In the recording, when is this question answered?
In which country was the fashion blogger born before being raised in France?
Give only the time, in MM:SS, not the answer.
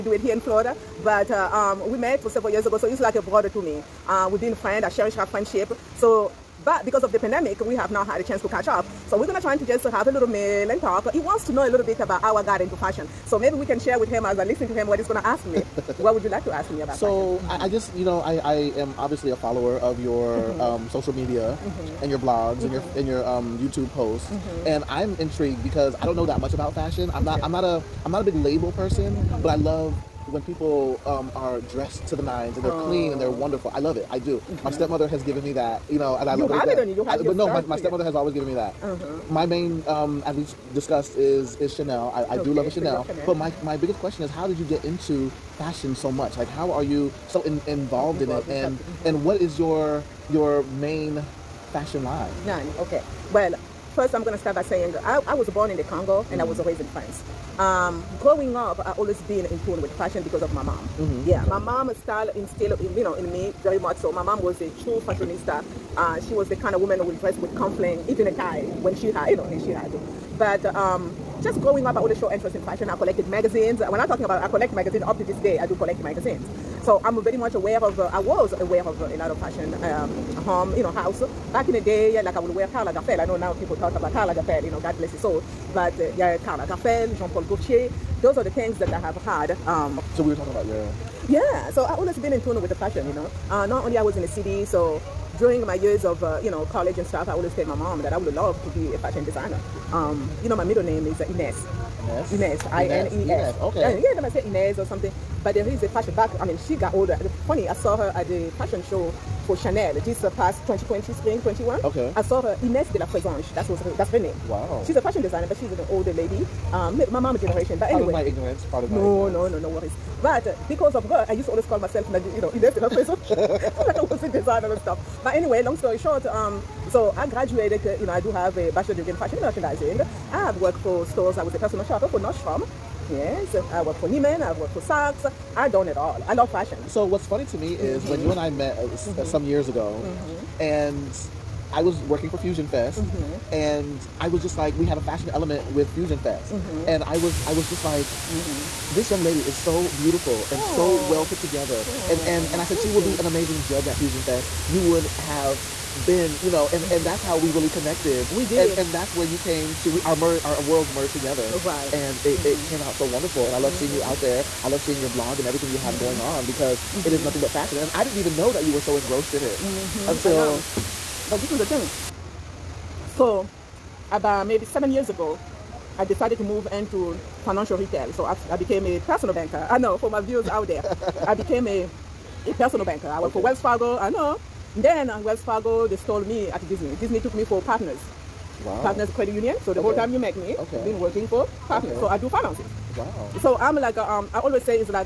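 00:55.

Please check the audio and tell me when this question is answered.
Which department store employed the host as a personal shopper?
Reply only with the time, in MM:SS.
02:12.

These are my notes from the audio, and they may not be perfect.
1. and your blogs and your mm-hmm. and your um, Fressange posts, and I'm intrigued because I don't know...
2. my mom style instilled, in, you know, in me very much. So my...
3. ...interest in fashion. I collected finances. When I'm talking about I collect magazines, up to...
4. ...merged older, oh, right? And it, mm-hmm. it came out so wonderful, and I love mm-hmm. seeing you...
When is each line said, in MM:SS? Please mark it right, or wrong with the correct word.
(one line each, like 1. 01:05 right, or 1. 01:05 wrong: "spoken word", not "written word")
1. 00:22 wrong: "YouTube", not "Fressange"
2. 01:01 right
3. 01:12 wrong: "magazines", not "finances"
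4. 02:40 wrong: "together", not "older".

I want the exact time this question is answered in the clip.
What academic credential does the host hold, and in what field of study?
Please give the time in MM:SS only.
02:08.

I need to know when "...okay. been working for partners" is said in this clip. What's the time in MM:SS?
03:10.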